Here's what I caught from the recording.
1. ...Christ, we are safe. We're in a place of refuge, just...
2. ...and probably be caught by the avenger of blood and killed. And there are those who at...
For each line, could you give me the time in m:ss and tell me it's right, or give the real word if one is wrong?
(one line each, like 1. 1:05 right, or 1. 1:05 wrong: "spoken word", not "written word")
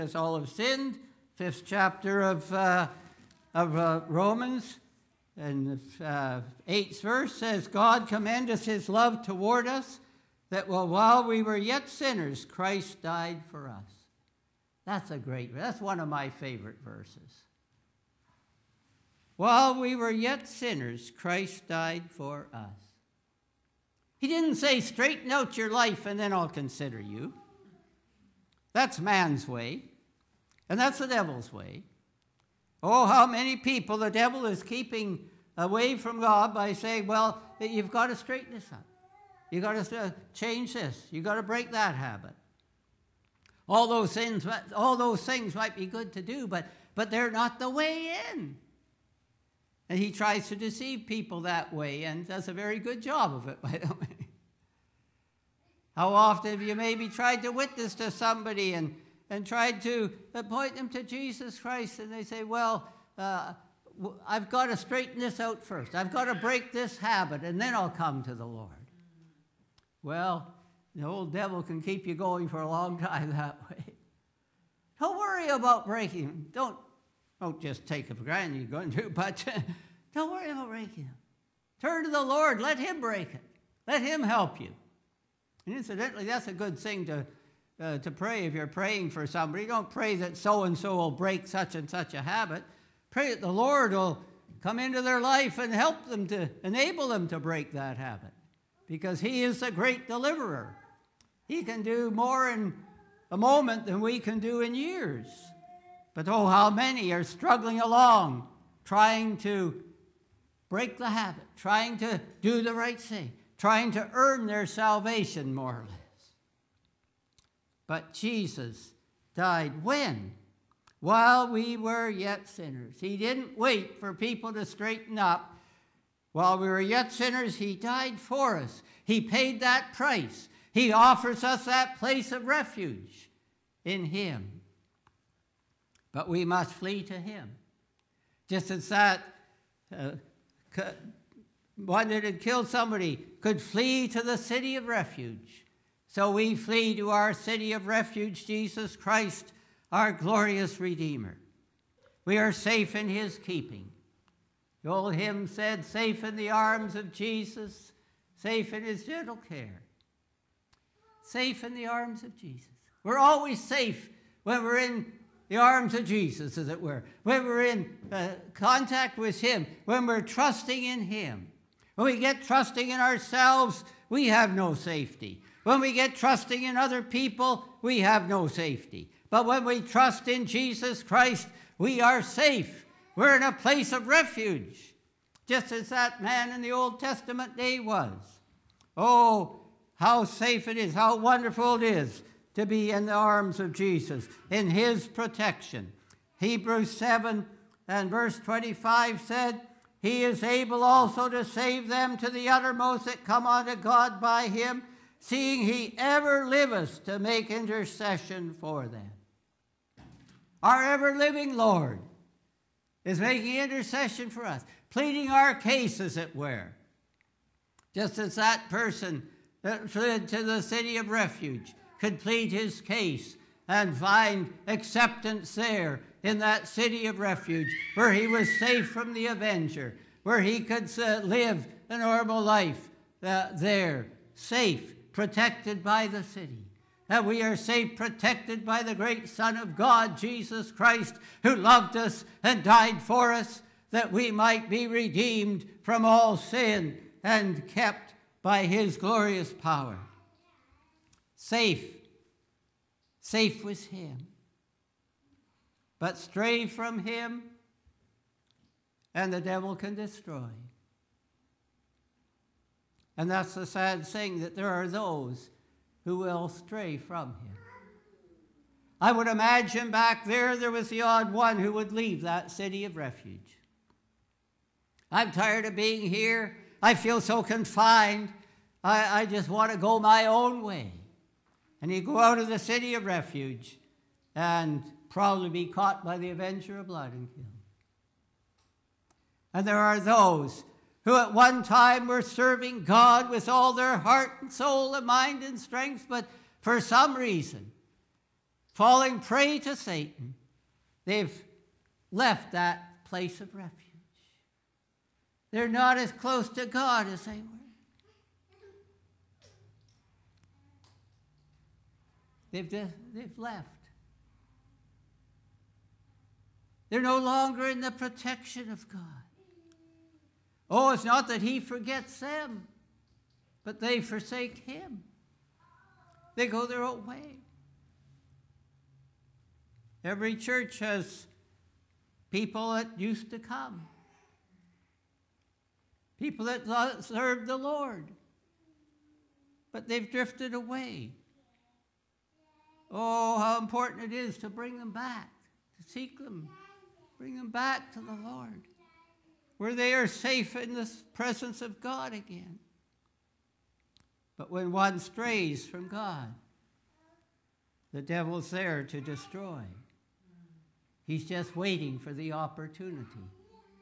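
1. 3:01 right
2. 4:44 right.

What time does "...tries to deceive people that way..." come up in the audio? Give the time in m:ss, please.
0:50.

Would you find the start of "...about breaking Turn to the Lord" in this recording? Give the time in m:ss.
1:20.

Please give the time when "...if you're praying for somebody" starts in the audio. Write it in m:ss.
1:28.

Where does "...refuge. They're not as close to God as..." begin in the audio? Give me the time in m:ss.
5:03.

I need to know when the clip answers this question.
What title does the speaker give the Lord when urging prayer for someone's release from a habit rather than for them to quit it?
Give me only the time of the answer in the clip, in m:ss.
1:39.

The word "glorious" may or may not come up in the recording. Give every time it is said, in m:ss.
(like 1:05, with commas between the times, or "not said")
2:30, 4:08.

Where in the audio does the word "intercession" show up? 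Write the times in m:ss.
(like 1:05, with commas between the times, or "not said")
3:27, 3:33.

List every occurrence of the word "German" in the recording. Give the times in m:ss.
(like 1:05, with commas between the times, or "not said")
not said.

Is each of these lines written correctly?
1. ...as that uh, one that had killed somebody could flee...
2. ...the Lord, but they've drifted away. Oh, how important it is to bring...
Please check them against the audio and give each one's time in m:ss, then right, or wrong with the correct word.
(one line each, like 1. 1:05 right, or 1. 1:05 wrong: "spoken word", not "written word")
1. 2:18 right
2. 5:37 right.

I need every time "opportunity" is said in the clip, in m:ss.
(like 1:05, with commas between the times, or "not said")
6:02.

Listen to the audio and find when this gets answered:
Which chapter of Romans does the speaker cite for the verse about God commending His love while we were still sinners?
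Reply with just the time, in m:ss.
0:01.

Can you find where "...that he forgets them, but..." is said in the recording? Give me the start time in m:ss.
5:21.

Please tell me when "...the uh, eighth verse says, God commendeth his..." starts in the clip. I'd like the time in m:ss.
0:05.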